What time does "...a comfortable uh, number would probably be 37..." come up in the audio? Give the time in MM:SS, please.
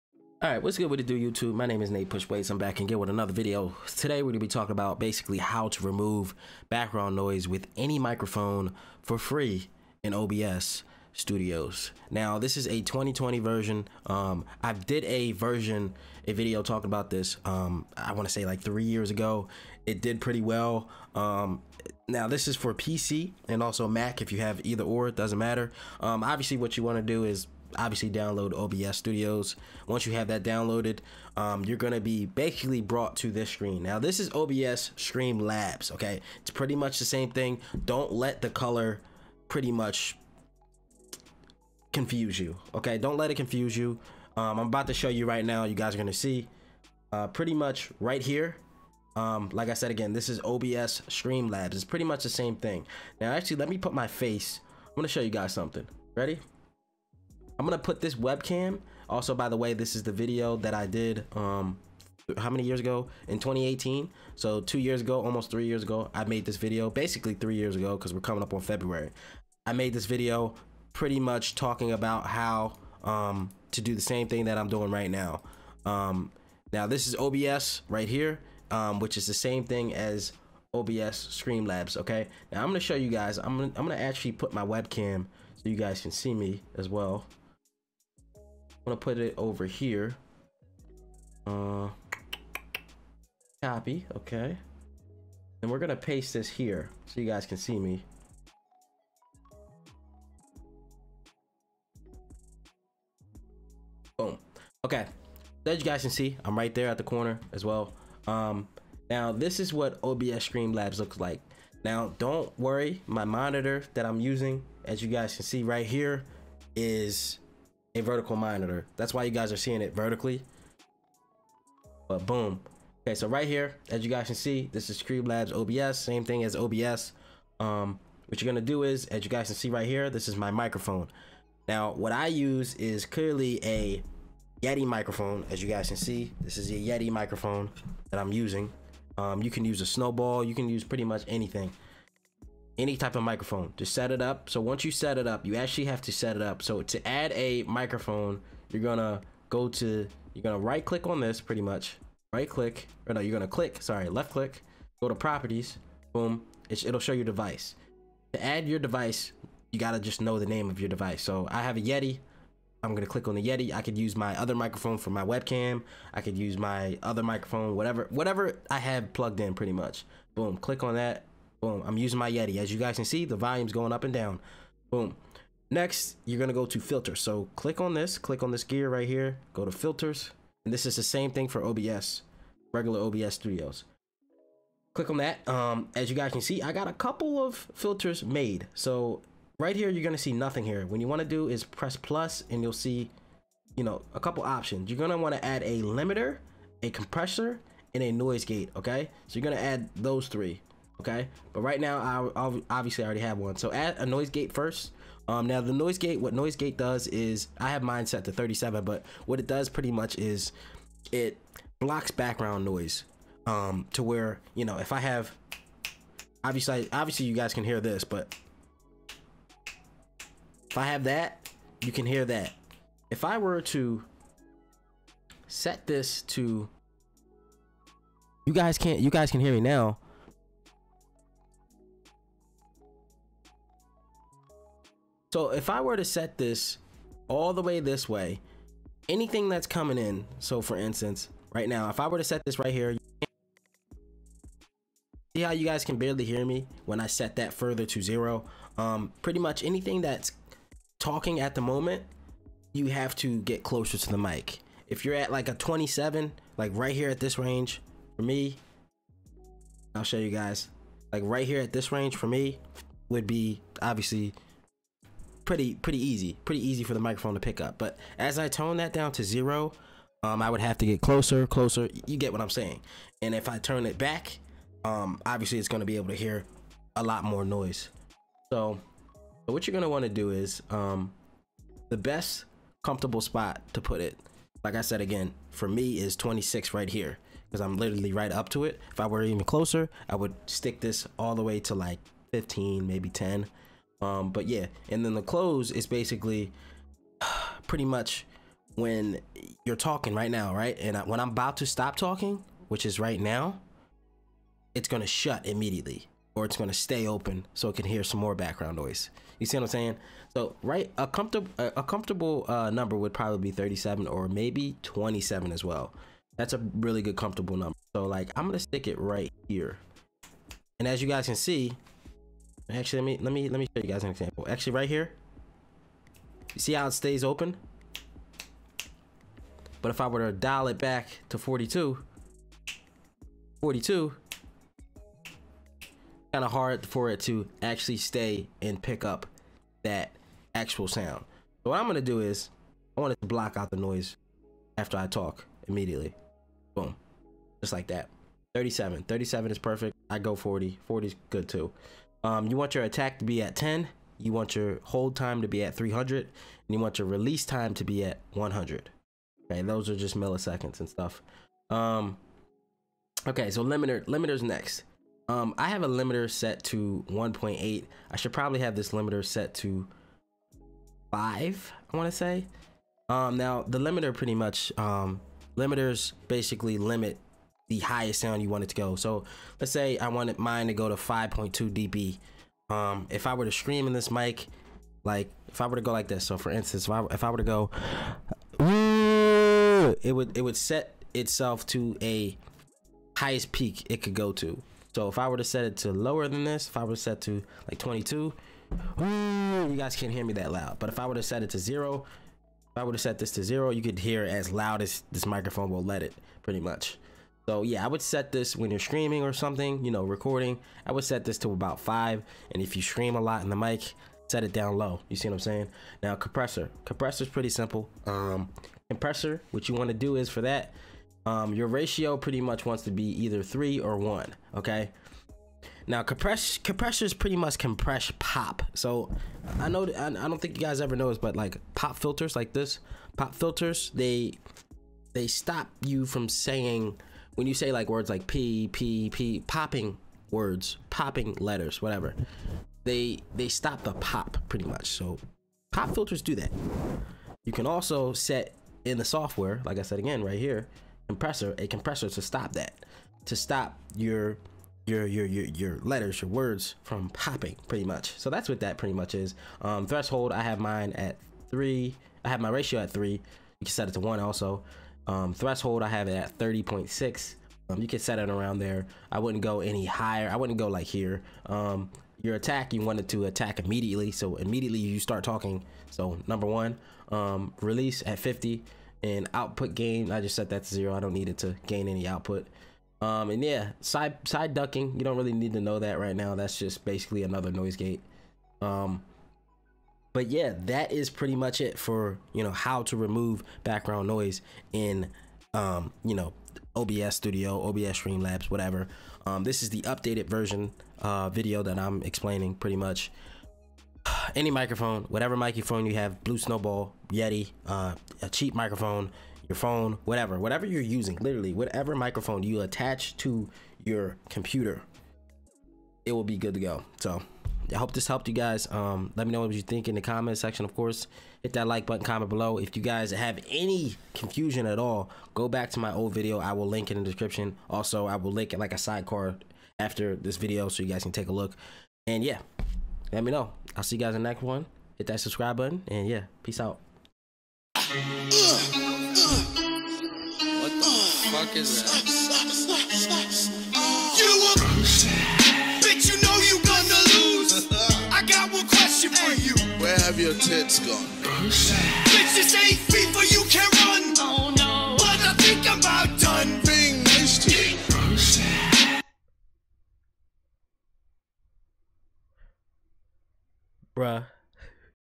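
05:11.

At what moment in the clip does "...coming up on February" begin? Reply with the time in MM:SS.
01:08.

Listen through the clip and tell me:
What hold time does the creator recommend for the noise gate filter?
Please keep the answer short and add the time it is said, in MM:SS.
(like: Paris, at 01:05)
300, at 05:54.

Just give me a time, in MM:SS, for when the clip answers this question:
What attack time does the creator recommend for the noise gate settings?
05:52.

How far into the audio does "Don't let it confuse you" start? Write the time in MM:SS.
00:42.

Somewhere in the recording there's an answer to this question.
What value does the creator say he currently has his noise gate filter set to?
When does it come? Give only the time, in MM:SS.
03:27.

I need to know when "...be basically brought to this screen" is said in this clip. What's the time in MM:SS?
00:32.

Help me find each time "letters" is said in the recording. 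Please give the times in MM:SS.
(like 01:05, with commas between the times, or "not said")
07:21, 07:35.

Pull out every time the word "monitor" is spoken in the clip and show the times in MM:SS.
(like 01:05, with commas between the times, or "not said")
01:53, 01:58.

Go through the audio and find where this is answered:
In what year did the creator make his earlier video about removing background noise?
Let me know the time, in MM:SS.
01:03.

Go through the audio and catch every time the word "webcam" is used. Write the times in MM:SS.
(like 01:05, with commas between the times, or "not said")
00:58, 01:24, 02:45.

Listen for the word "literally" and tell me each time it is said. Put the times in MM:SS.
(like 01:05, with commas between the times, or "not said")
04:47, 08:31.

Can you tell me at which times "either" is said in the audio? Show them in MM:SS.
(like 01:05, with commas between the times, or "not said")
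00:24, 07:03.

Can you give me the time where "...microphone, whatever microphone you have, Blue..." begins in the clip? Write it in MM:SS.
08:24.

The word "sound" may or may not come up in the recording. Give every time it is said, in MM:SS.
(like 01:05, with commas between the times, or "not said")
05:40, 06:18.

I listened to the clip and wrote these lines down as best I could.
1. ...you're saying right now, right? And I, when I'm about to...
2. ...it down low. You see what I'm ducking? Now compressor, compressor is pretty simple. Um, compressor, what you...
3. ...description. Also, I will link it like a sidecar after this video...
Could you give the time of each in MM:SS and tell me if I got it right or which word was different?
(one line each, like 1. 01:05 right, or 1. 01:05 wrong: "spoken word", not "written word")
1. 04:59 wrong: "talking", not "saying"
2. 06:54 wrong: "saying", not "ducking"
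3. 08:47 right.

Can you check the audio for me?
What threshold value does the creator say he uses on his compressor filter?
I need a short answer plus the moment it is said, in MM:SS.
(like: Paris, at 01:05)
30.6, at 07:46.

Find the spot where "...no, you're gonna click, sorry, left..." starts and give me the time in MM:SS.
02:33.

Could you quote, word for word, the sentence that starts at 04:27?
But as I tone that down to zero, um, I would have to get closer, closer.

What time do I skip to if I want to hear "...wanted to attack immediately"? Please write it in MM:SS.
07:52.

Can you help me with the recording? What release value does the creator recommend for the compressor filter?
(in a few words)
50.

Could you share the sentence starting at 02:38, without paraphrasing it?
To add your device, you gotta just know the name of your device.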